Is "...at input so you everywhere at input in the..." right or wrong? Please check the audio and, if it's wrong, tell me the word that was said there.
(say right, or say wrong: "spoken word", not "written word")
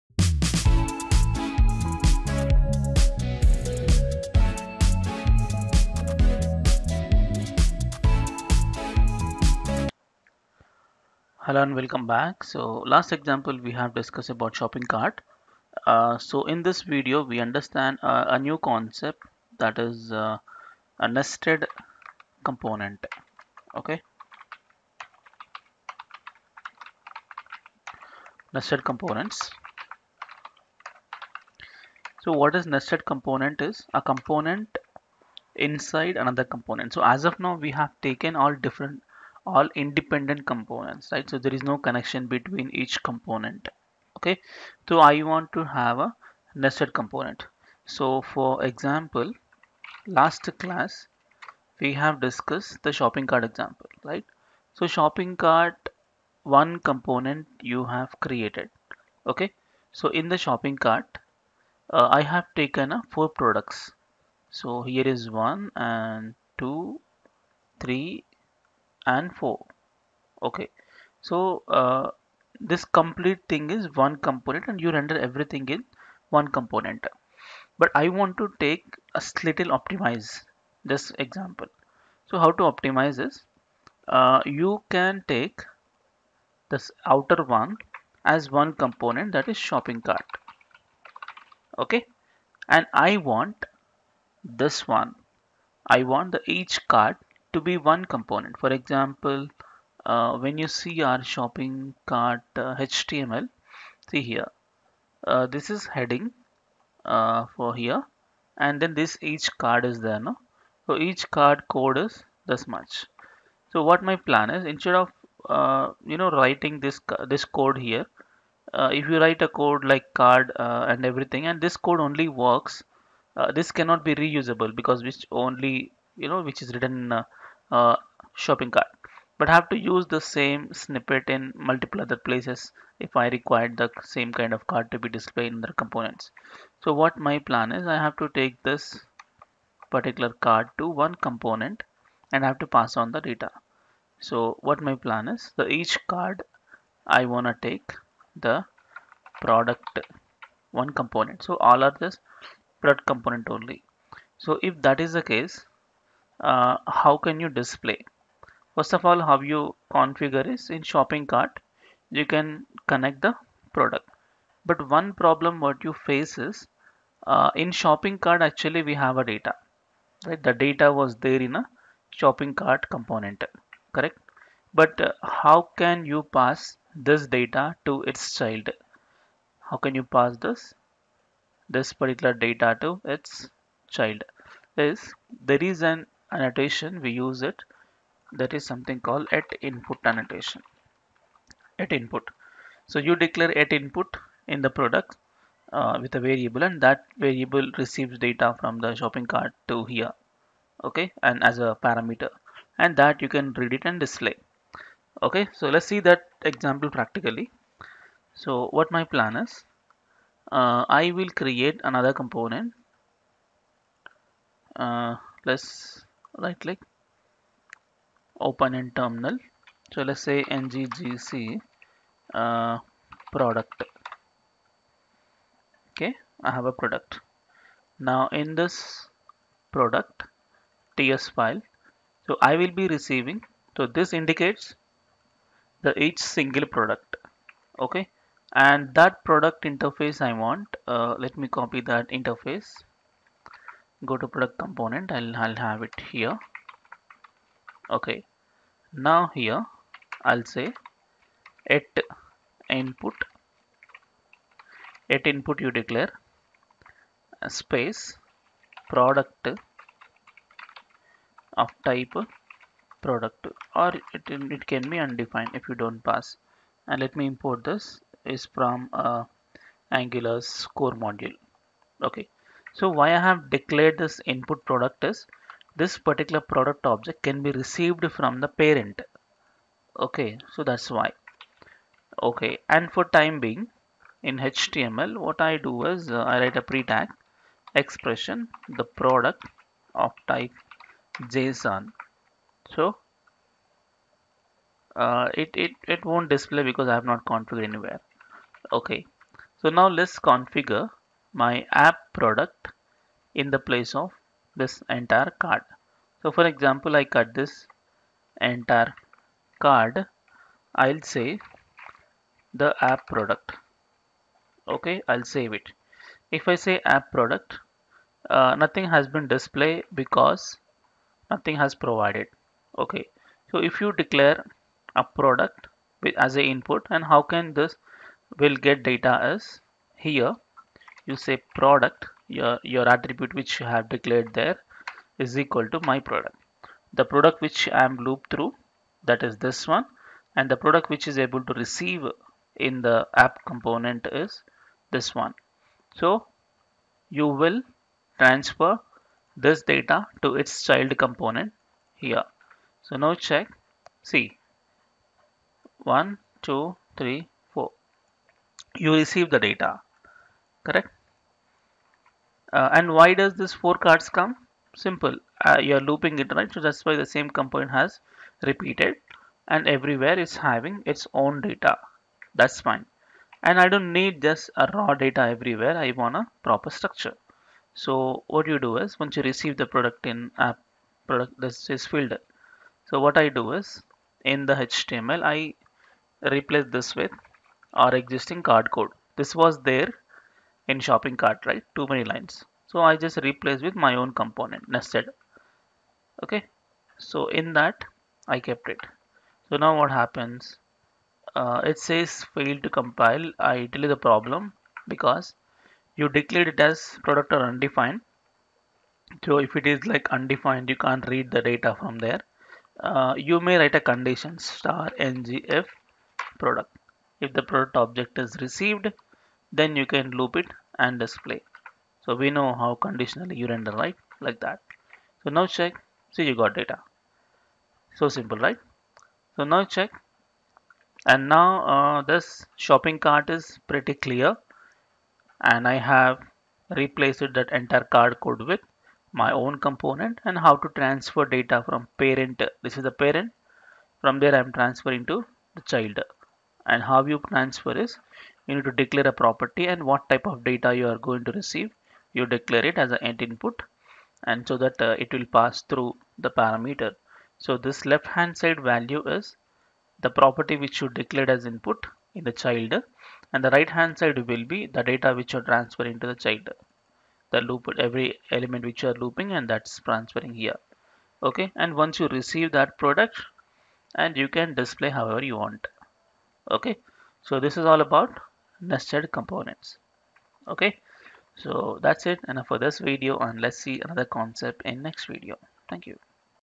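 wrong: "declare", not "everywhere".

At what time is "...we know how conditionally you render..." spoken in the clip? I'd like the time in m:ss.
7:02.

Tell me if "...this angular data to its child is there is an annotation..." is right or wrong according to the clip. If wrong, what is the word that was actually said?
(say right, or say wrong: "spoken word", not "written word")
wrong: "particular", not "angular".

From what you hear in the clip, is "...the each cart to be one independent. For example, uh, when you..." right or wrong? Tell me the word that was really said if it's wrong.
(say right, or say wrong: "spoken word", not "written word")
wrong: "component", not "independent".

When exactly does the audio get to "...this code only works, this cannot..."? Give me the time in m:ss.
2:01.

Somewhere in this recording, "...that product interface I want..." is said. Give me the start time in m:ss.
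3:58.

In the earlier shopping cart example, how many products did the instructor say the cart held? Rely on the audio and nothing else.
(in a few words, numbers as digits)
4.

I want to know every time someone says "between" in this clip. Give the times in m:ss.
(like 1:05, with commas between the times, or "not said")
0:42.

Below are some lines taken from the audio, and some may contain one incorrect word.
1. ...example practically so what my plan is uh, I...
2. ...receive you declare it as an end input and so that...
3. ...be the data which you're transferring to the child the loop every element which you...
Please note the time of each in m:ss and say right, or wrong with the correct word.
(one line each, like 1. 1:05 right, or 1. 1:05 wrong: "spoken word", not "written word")
1. 3:26 right
2. 7:31 right
3. 7:44 right.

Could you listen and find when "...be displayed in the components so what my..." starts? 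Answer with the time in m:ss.
2:14.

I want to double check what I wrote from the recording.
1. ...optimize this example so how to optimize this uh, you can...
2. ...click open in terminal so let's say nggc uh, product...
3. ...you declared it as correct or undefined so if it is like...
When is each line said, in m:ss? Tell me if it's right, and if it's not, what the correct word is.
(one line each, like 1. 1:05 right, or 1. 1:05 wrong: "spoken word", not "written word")
1. 1:19 right
2. 3:36 right
3. 6:45 wrong: "product", not "correct".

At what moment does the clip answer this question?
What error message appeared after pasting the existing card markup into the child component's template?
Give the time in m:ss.
6:42.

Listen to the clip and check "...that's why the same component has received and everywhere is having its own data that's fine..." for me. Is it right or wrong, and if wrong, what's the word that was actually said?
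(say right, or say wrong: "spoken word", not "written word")
wrong: "repeated", not "received".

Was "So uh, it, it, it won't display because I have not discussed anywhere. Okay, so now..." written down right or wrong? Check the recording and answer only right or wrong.
wrong.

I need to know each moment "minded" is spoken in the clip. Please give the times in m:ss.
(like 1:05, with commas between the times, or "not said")
not said.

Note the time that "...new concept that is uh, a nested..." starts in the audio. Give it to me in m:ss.
0:18.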